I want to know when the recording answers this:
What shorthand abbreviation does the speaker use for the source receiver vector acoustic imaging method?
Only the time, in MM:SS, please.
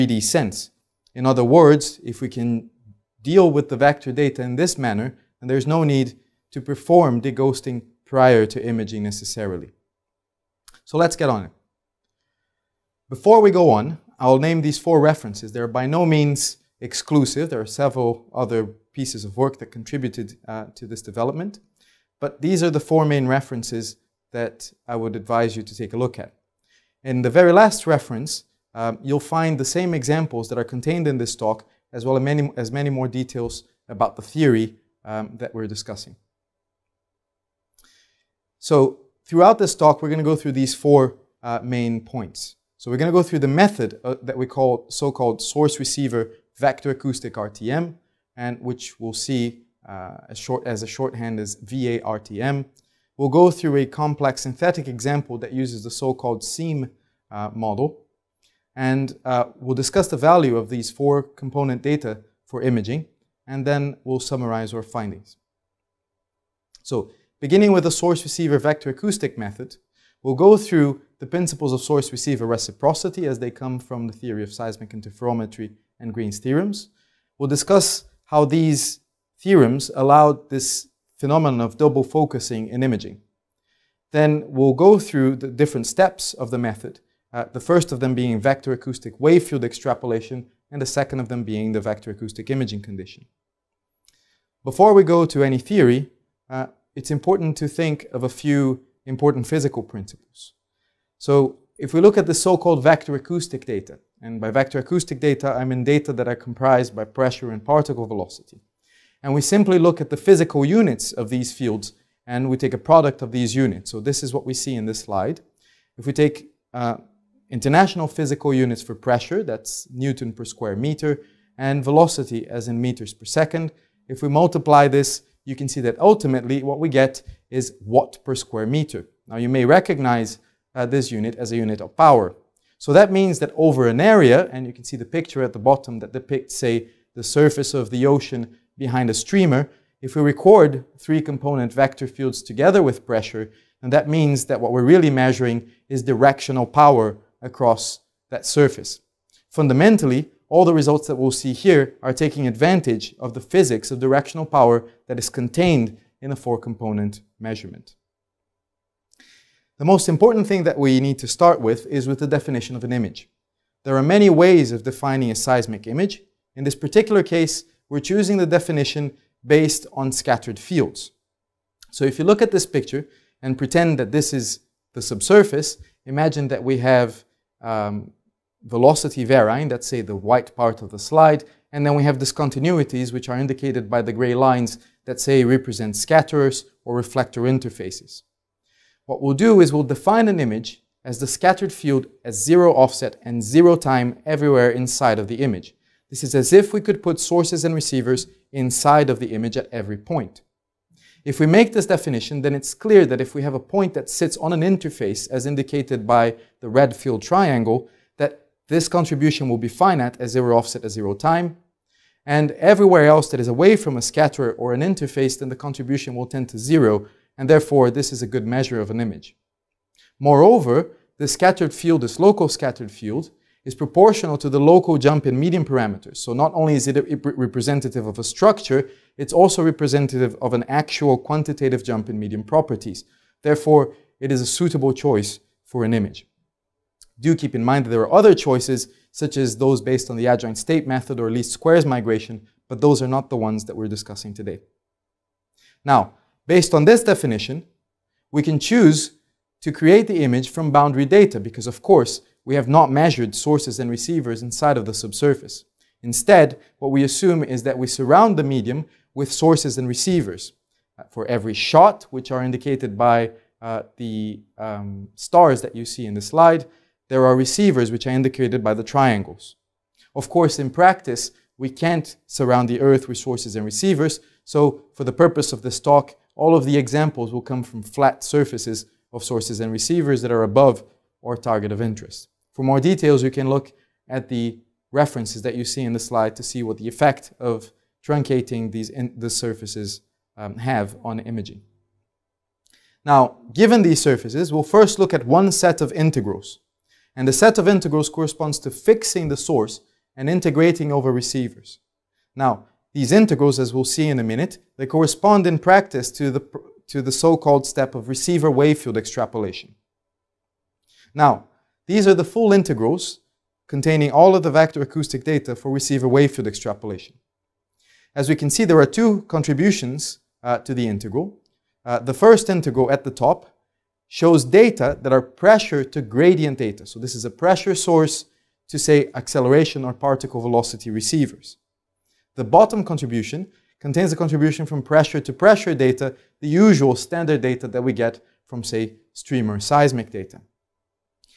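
00:51.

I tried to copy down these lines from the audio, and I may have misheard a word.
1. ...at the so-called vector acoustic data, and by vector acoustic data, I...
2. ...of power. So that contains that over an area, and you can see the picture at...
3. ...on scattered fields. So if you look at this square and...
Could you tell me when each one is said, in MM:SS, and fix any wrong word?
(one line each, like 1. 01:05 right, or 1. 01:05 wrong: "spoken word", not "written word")
1. 01:42 right
2. 02:11 wrong: "means", not "contains"
3. 02:49 wrong: "picture", not "square".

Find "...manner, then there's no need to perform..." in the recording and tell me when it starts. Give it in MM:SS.
00:04.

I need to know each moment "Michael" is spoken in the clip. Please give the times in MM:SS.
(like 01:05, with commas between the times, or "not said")
not said.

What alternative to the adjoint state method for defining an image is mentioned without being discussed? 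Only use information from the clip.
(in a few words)
least squares migration.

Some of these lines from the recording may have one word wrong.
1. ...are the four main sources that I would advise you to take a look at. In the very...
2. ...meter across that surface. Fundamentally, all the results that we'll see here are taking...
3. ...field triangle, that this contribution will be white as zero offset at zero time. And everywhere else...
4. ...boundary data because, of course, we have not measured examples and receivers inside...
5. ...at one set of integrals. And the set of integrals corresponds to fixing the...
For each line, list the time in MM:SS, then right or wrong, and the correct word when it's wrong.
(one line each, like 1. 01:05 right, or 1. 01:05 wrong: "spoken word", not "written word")
1. 00:22 wrong: "references", not "sources"
2. 02:26 wrong: "power", not "meter"
3. 03:26 wrong: "finite", not "white"
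4. 04:10 wrong: "sources", not "examples"
5. 04:55 right.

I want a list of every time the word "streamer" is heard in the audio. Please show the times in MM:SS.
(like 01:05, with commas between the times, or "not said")
02:19, 05:39.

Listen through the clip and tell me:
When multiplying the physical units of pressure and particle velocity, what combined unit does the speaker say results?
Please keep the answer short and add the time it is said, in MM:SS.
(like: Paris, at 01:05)
watt per square meter, at 02:07.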